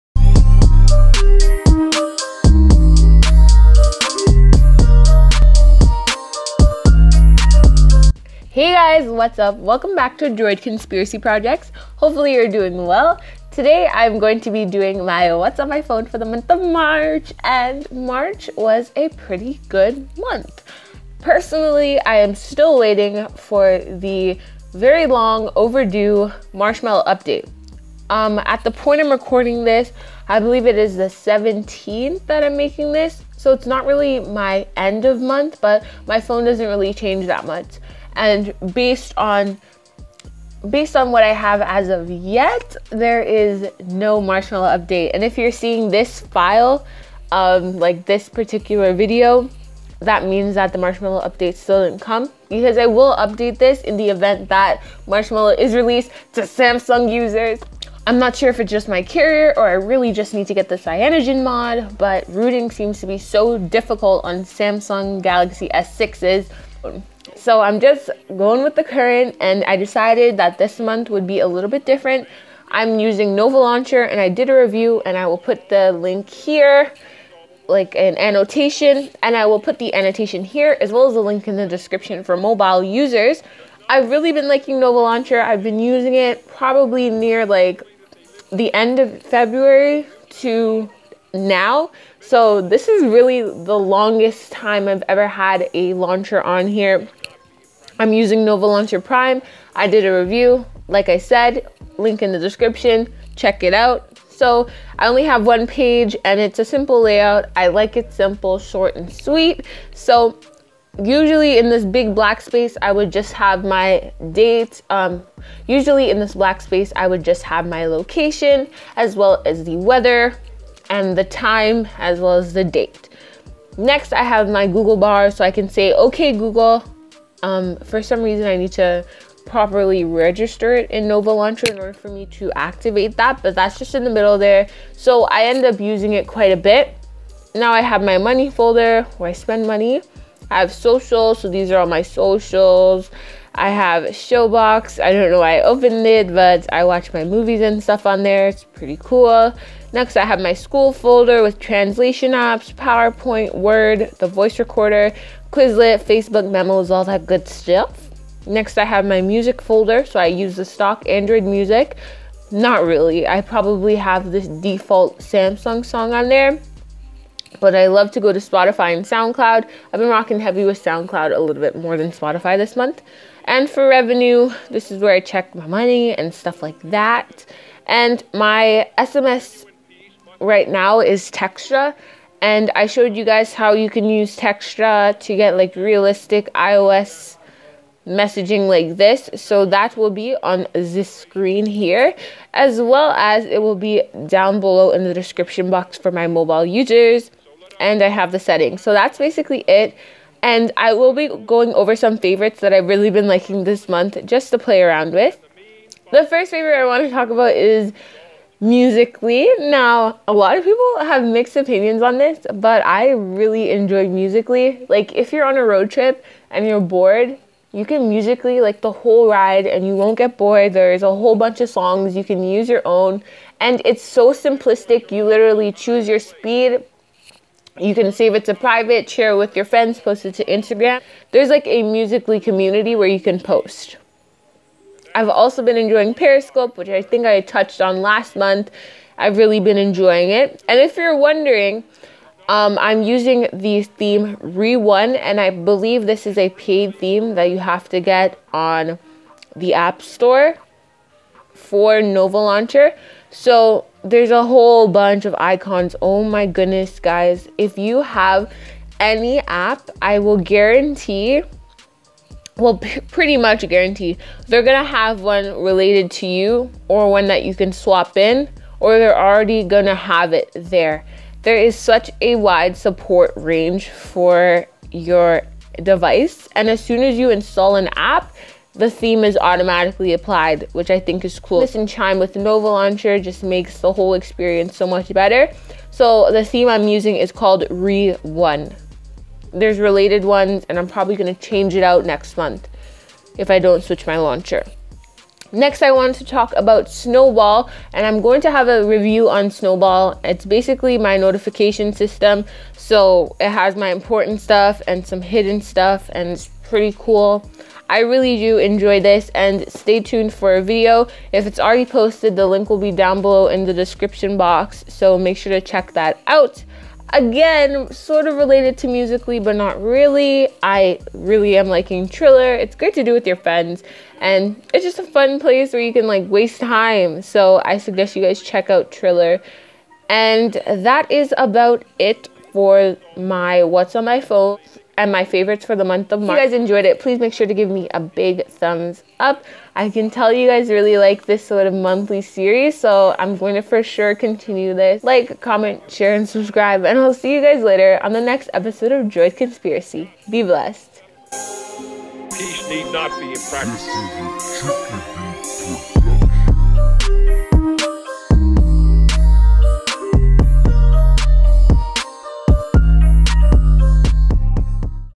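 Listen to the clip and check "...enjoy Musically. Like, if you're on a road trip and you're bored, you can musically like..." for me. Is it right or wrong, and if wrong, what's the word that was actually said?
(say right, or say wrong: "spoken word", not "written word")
right.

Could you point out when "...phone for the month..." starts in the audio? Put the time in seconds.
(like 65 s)
15 s.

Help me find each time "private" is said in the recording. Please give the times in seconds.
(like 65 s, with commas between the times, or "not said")
228 s.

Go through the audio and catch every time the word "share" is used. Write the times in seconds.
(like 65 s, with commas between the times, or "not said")
229 s, 345 s.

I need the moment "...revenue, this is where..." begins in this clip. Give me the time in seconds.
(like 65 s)
173 s.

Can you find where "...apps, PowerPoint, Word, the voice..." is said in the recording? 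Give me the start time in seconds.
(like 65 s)
152 s.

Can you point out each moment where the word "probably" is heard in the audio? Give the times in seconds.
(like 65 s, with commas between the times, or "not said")
86 s, 163 s, 290 s.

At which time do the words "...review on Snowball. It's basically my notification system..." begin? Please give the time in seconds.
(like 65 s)
298 s.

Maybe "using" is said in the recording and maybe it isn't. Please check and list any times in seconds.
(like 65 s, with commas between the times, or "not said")
72 s, 85 s, 98 s, 135 s, 243 s, 286 s.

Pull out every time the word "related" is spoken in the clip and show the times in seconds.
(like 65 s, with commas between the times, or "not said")
265 s, 289 s, 318 s.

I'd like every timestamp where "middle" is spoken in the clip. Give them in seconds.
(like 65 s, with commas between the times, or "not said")
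134 s.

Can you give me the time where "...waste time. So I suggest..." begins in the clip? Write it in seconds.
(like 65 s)
326 s.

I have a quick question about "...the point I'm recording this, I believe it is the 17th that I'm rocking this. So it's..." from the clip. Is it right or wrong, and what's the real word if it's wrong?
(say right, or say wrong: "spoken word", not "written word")
wrong: "making", not "rocking".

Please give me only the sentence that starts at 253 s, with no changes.
So there's a whole bunch of icons.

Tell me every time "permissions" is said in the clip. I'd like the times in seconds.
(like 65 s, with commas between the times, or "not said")
not said.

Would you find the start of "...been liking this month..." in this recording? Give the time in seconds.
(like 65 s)
203 s.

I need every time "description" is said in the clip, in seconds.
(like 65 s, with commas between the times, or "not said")
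81 s, 102 s, 195 s, 313 s.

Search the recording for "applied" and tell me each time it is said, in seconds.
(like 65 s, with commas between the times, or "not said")
280 s.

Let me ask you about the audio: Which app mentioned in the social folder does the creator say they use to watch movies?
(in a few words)
Showbox.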